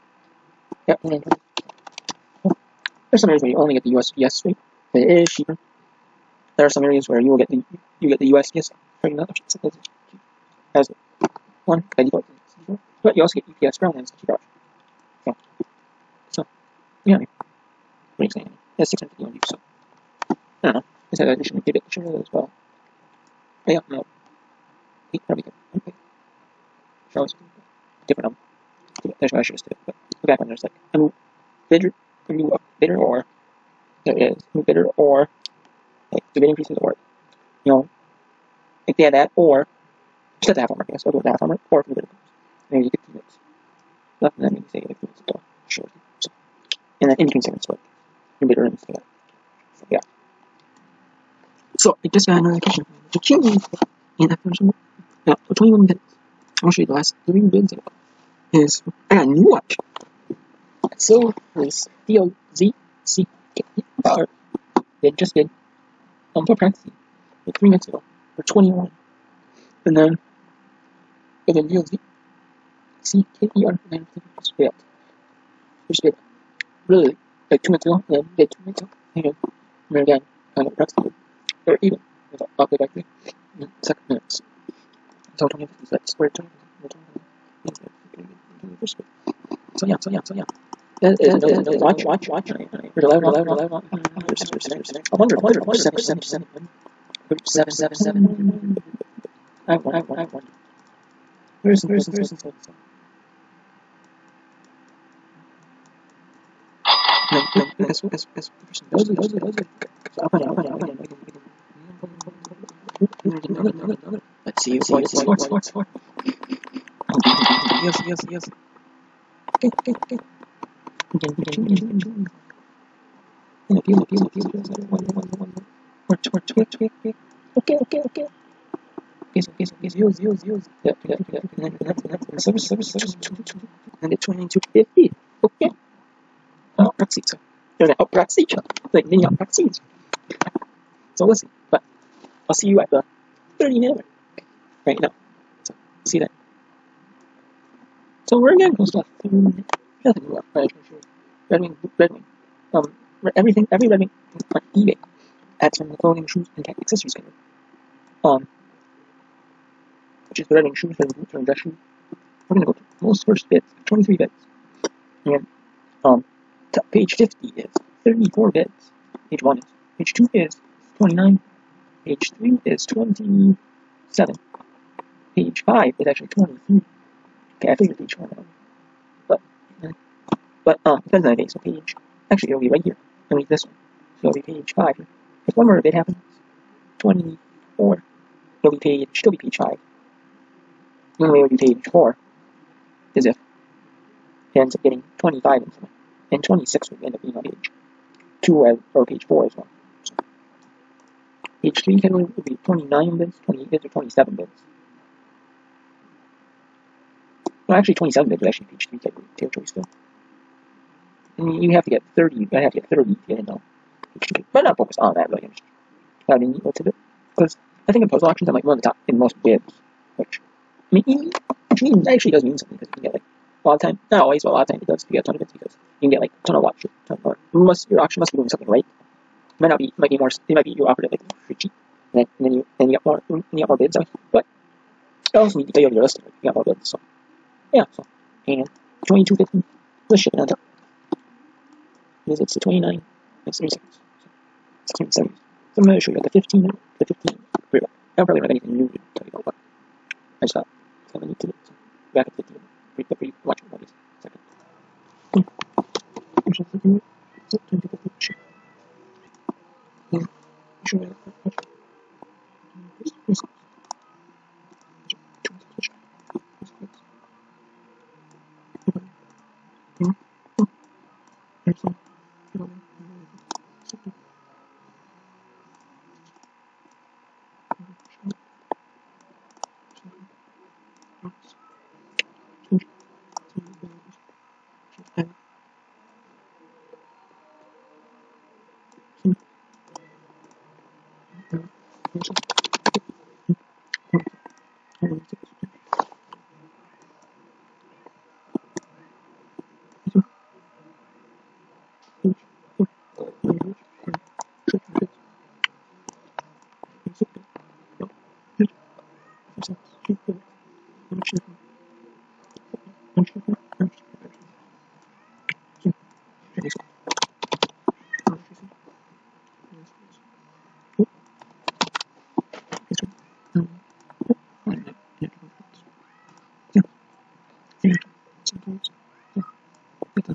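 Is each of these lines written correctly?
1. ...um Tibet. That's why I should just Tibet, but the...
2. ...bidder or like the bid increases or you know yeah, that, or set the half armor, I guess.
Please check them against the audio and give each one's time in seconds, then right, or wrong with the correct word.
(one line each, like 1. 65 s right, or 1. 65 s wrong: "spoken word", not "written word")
1. 28 s right
2. 34 s right.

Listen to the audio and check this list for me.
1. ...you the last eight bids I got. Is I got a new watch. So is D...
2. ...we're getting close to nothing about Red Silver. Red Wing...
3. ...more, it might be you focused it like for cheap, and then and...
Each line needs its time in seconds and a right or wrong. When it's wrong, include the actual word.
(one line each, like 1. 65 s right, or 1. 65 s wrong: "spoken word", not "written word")
1. 56 s wrong: "three", not "eight"
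2. 148 s wrong: "Wing", not "Silver"
3. 230 s wrong: "offered", not "focused".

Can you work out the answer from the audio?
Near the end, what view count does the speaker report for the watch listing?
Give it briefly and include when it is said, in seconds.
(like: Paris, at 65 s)
670, at 244 s.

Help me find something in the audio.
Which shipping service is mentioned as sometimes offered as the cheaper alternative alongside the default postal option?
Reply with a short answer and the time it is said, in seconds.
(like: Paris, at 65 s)
UPS ground, at 13 s.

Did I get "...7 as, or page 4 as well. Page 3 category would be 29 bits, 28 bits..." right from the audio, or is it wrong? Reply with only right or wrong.
wrong.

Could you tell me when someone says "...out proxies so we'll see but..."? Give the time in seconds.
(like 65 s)
139 s.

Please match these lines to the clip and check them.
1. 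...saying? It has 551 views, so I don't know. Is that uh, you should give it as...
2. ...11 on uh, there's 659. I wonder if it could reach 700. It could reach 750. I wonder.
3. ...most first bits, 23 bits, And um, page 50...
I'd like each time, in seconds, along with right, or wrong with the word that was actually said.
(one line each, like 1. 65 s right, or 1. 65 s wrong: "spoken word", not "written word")
1. 18 s wrong: "651", not "551"
2. 93 s wrong: "700", not "750"
3. 163 s right.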